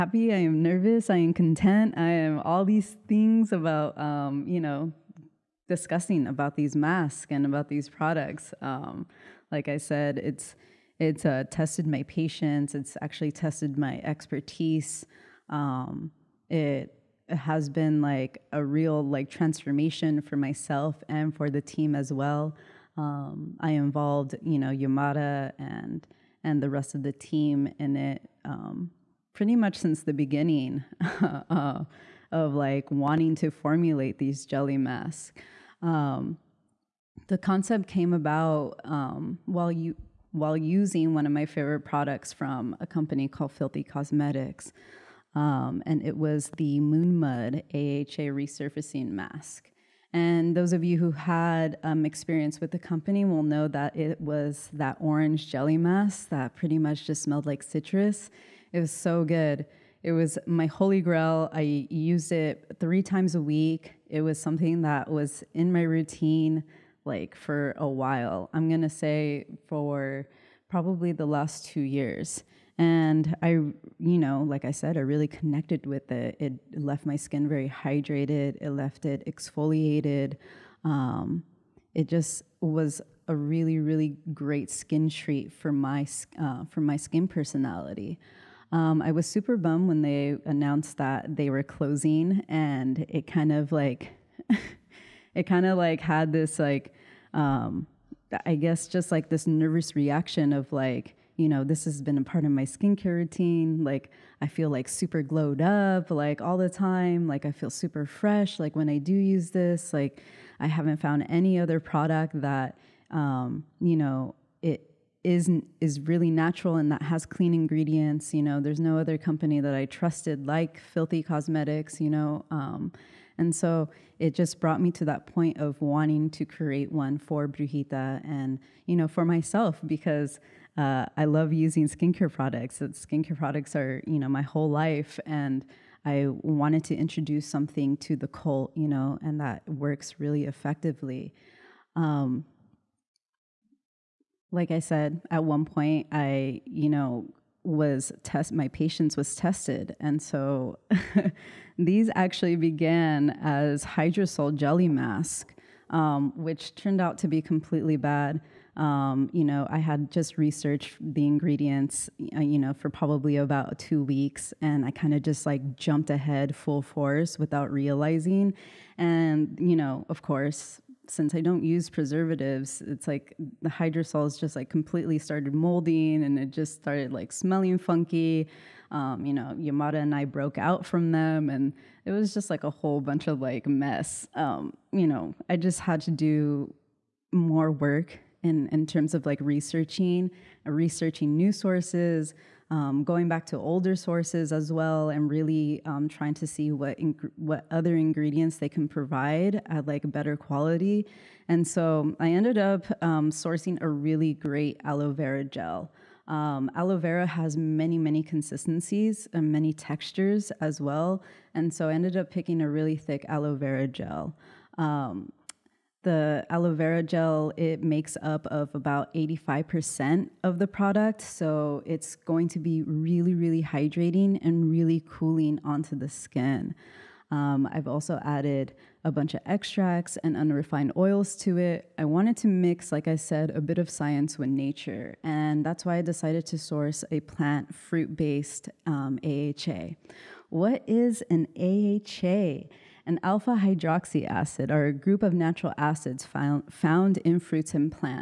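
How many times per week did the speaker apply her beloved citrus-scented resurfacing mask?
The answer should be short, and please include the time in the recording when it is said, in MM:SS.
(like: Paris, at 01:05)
3 times a week, at 01:02.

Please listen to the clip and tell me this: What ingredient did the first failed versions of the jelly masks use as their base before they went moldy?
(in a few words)
hydrosol.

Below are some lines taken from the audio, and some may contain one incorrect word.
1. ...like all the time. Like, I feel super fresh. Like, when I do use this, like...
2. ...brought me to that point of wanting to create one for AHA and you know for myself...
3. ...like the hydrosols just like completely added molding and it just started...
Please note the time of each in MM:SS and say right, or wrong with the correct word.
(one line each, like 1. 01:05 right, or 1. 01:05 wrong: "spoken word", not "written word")
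1. 01:46 right
2. 02:04 wrong: "Brujita", not "AHA"
3. 02:53 wrong: "started", not "added".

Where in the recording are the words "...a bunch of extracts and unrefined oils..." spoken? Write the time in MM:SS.
03:49.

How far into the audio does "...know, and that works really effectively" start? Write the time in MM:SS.
02:18.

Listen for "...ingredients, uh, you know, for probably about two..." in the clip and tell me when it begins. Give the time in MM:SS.
02:41.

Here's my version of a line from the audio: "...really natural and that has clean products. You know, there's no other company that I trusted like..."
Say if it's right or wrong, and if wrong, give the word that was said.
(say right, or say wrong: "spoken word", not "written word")
wrong: "ingredients", not "products".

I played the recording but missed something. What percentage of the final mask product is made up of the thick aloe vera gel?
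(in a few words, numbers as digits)
85%.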